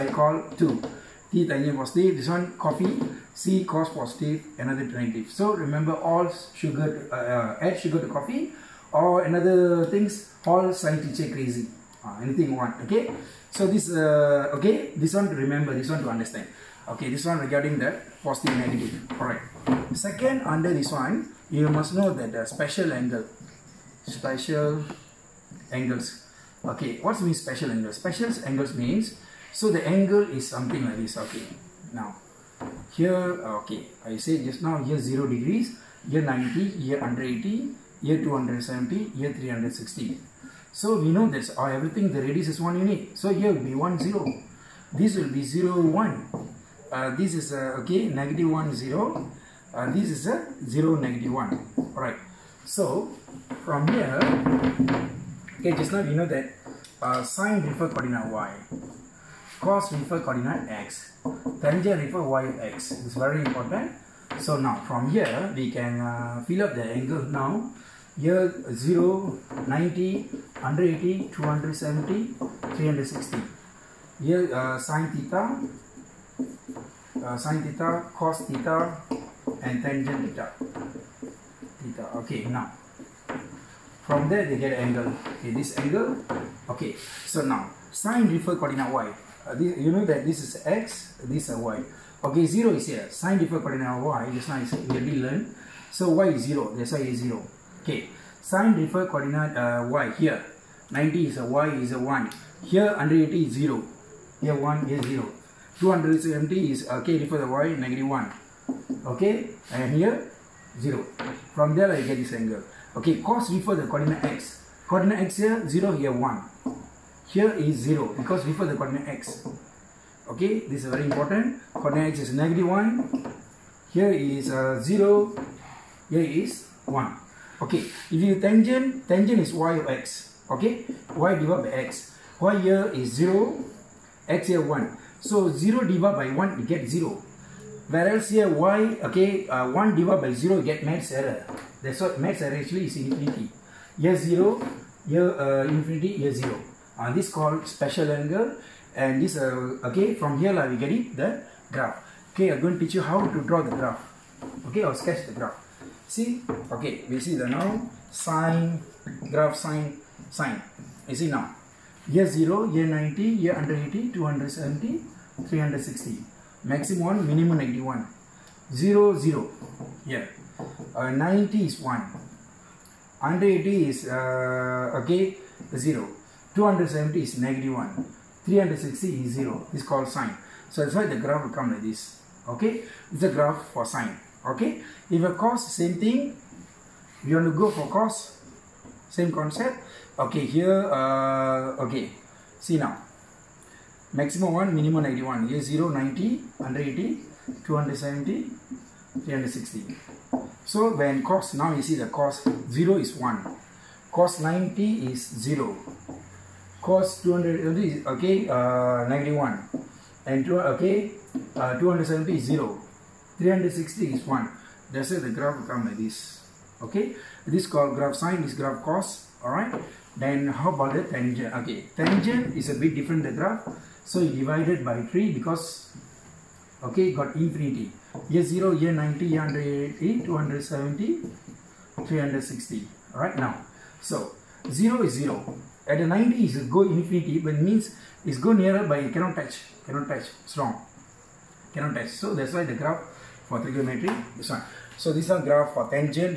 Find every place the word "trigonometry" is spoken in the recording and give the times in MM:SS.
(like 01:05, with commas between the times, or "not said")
04:03.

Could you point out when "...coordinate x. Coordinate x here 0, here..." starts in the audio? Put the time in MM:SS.
01:53.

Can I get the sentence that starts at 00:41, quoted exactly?
or oh, everything the radius is 1 unit.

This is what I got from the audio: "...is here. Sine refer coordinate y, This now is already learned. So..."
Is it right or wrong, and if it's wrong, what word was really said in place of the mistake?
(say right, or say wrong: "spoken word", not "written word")
right.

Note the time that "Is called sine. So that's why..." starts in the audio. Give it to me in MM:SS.
02:59.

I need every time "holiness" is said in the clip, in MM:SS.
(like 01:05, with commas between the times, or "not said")
not said.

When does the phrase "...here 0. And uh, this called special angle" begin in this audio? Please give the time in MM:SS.
02:26.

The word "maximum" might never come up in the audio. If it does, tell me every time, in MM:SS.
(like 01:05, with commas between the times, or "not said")
02:46, 03:14.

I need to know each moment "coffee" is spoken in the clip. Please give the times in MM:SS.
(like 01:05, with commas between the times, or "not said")
00:02, 00:08.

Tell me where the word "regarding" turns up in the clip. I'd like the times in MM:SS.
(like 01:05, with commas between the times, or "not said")
00:17.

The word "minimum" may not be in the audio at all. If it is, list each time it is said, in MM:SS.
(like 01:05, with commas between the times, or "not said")
02:47, 03:14.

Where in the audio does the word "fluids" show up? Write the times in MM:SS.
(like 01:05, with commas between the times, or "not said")
not said.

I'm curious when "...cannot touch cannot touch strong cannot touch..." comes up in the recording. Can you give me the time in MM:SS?
03:59.